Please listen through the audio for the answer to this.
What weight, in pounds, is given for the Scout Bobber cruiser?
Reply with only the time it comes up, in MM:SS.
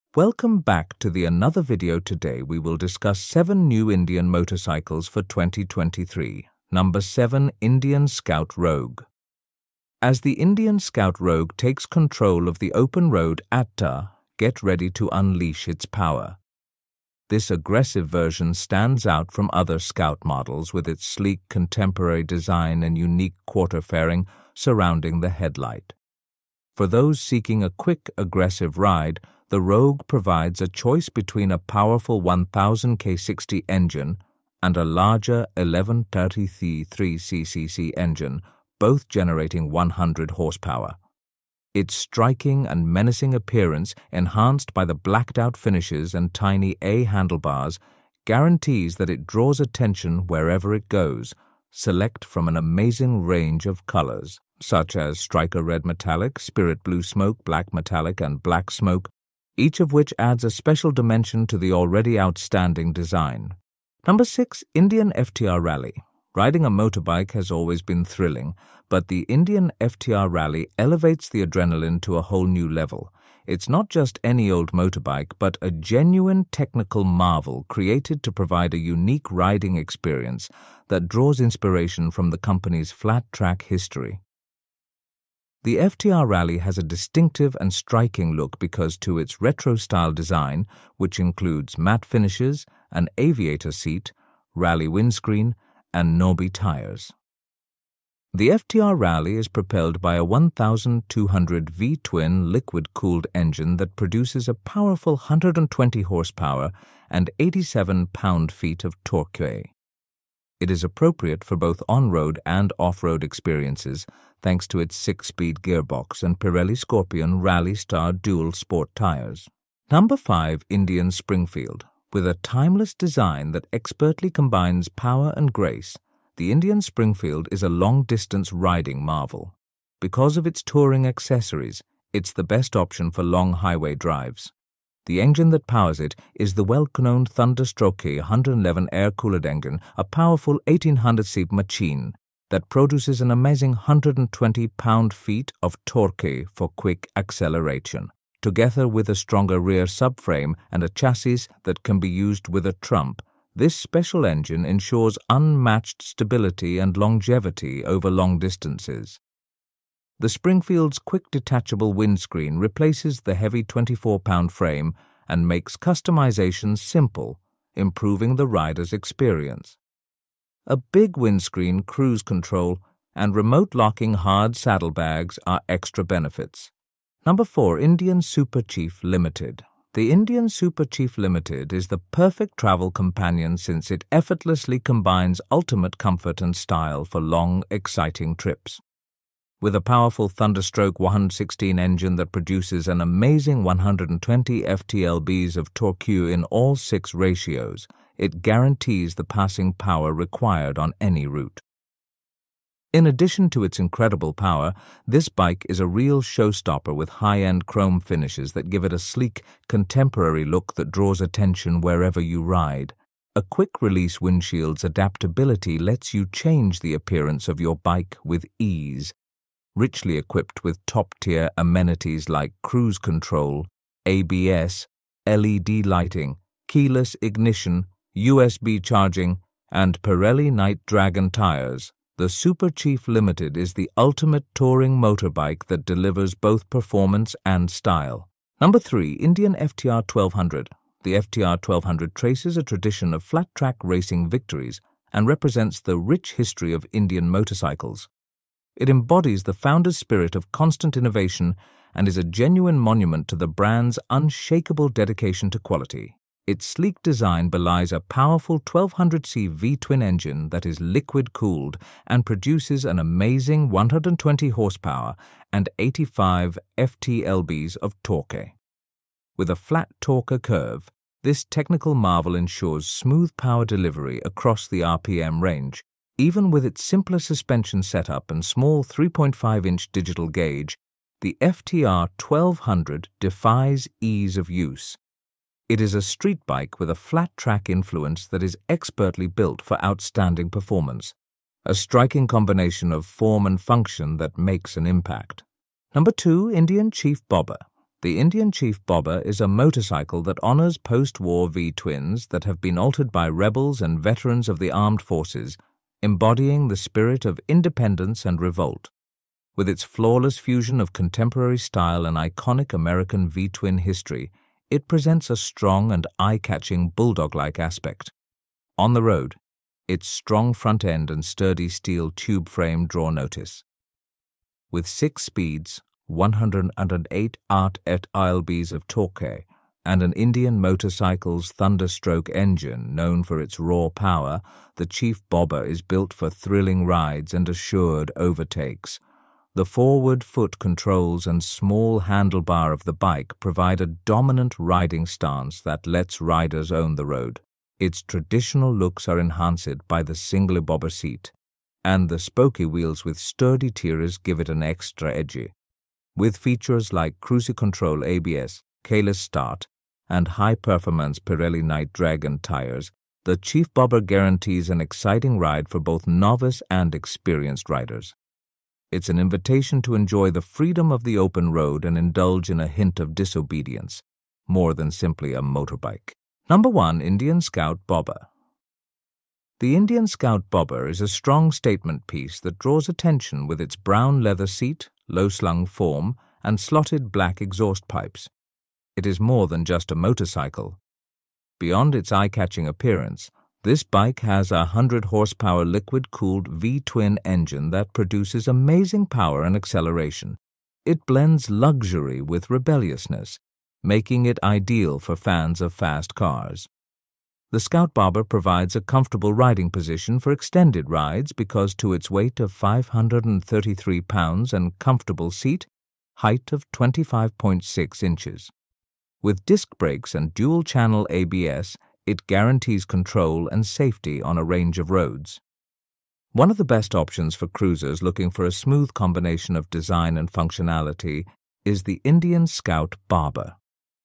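06:52.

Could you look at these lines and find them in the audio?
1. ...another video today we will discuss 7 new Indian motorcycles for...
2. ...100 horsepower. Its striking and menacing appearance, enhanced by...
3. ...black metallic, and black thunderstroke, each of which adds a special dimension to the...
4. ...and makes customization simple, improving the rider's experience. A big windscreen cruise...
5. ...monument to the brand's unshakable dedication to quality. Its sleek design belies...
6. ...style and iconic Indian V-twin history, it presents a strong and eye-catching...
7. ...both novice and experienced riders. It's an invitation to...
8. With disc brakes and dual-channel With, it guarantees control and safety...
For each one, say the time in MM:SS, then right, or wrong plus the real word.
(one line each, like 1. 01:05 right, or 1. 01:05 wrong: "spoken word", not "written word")
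1. 00:01 right
2. 00:39 right
3. 00:57 wrong: "smoke", not "thunderstroke"
4. 02:45 right
5. 04:12 right
6. 05:11 wrong: "American", not "Indian"
7. 06:05 right
8. 06:59 wrong: "ABS", not "With".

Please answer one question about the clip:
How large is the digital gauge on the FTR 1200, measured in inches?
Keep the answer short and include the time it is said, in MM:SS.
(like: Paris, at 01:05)
3.5 inches, at 04:38.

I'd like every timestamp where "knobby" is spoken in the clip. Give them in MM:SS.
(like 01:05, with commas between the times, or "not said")
01:36.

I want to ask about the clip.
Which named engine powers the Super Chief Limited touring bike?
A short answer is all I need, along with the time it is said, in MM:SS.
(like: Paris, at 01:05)
Thunderstroke 116, at 03:10.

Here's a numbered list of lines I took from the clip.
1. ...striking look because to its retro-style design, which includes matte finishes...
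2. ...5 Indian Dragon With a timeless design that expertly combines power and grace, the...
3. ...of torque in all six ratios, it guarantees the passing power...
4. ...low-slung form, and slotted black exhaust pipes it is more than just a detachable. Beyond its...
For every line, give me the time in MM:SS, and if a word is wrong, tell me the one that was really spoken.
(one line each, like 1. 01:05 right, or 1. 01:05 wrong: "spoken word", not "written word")
1. 01:27 right
2. 02:00 wrong: "Springfield", not "Dragon"
3. 03:15 right
4. 06:25 wrong: "motorcycle", not "detachable".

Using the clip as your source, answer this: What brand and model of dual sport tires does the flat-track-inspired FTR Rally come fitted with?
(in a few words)
Pirelli Scorpion Rally Star.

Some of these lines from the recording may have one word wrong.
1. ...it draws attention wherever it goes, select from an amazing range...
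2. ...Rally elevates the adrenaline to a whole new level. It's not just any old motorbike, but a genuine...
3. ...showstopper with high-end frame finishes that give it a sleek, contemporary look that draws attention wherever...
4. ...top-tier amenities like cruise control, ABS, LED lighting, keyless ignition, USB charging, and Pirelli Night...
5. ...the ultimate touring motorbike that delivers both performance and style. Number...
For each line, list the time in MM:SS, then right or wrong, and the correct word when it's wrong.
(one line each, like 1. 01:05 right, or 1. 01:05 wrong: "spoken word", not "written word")
1. 00:49 right
2. 01:10 right
3. 03:26 wrong: "chrome", not "frame"
4. 03:40 right
5. 03:53 right.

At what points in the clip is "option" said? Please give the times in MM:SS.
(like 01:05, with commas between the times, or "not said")
02:12, 07:06.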